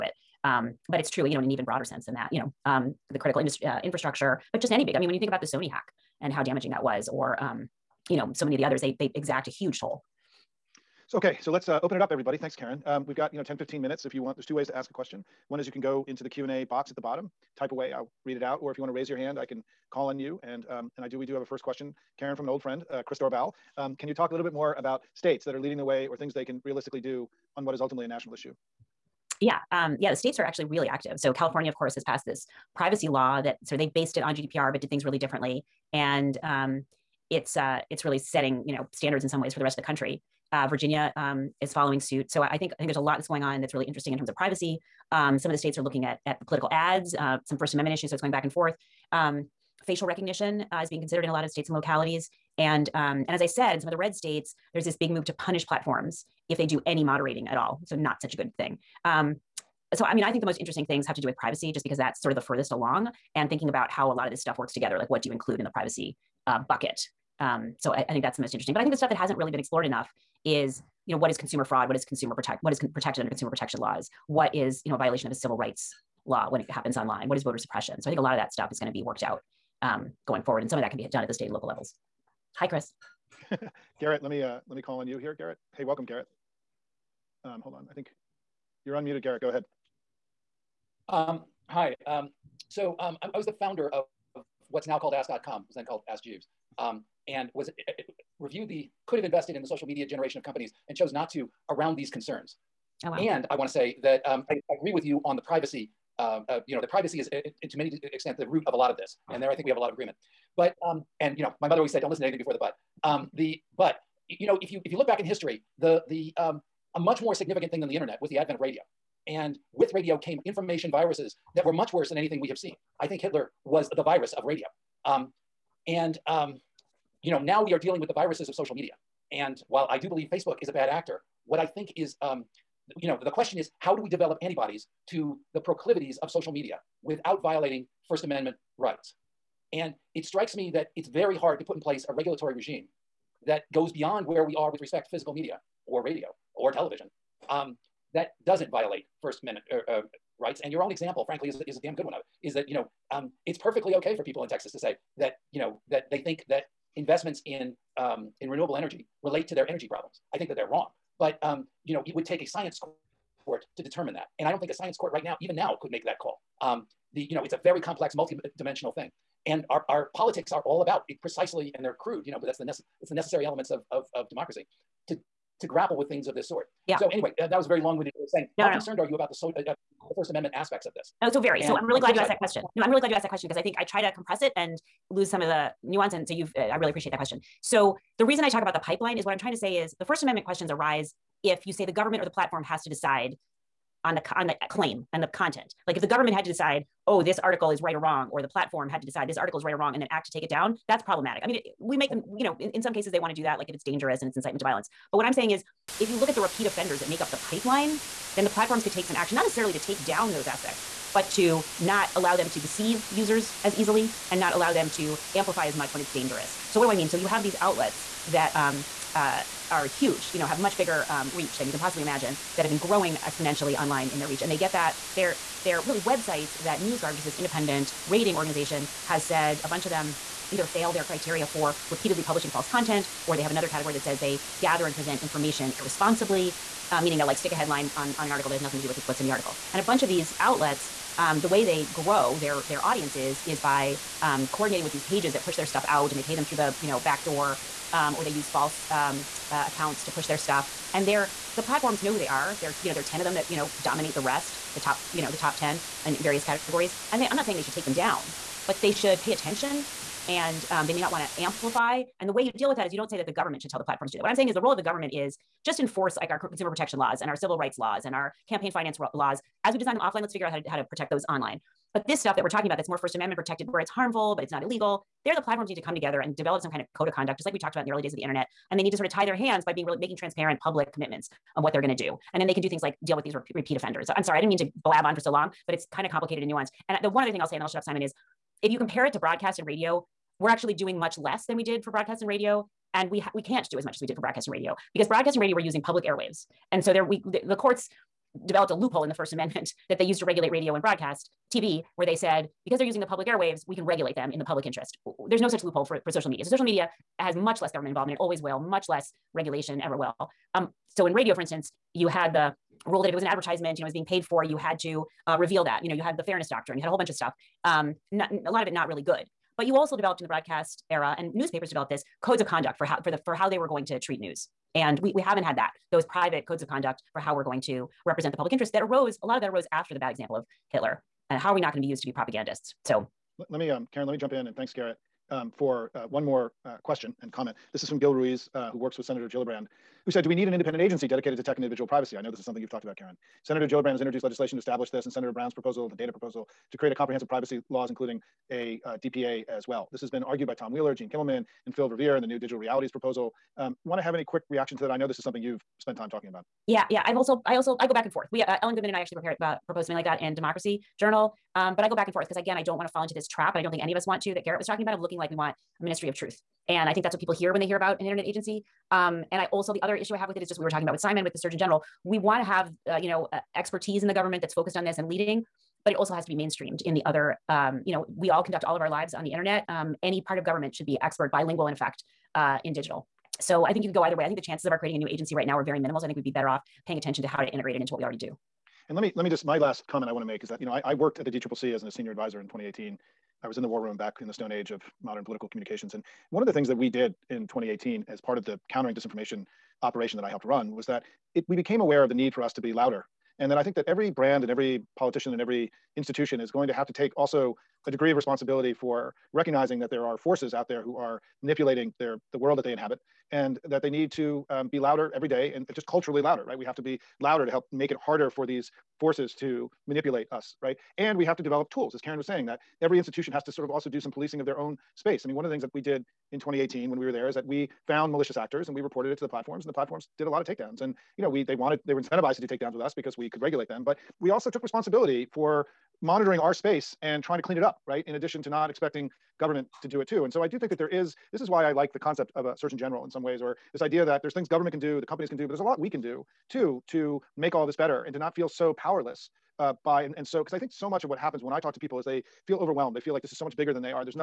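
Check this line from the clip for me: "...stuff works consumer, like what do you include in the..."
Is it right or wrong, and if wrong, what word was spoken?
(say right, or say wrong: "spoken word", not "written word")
wrong: "together", not "consumer".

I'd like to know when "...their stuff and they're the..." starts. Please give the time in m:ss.
4:10.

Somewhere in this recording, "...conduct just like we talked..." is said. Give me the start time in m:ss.
4:37.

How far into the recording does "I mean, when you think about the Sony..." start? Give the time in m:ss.
0:04.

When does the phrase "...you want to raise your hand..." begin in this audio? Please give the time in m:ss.
0:18.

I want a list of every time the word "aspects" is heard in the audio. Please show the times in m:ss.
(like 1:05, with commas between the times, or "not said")
3:00, 3:30.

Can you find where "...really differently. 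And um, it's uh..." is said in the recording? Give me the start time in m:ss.
0:35.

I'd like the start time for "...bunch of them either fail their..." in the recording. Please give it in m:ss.
3:49.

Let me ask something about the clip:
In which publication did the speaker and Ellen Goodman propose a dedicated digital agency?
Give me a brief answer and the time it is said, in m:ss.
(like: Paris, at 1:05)
Democracy Journal, at 6:00.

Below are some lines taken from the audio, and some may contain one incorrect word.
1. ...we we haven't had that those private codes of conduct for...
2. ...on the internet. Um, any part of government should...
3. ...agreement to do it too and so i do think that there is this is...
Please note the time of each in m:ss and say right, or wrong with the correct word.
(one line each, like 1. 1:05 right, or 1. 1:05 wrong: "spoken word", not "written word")
1. 5:24 right
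2. 6:19 right
3. 7:19 wrong: "government", not "agreement".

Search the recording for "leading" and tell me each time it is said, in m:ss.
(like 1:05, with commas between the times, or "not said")
0:25, 6:15.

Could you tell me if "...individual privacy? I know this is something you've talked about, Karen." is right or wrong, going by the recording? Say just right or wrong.
right.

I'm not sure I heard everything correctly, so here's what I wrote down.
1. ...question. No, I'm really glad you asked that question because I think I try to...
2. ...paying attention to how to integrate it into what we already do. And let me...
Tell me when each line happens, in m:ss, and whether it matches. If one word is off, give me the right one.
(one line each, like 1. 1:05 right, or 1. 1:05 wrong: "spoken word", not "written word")
1. 3:02 right
2. 6:26 right.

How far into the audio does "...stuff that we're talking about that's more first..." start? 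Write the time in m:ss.
4:32.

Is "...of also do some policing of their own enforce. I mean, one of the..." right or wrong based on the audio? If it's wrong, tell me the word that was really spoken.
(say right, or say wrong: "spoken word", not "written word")
wrong: "space", not "enforce".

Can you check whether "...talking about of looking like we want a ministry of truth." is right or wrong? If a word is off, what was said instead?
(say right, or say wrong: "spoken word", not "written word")
right.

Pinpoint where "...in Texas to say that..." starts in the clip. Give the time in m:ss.
2:34.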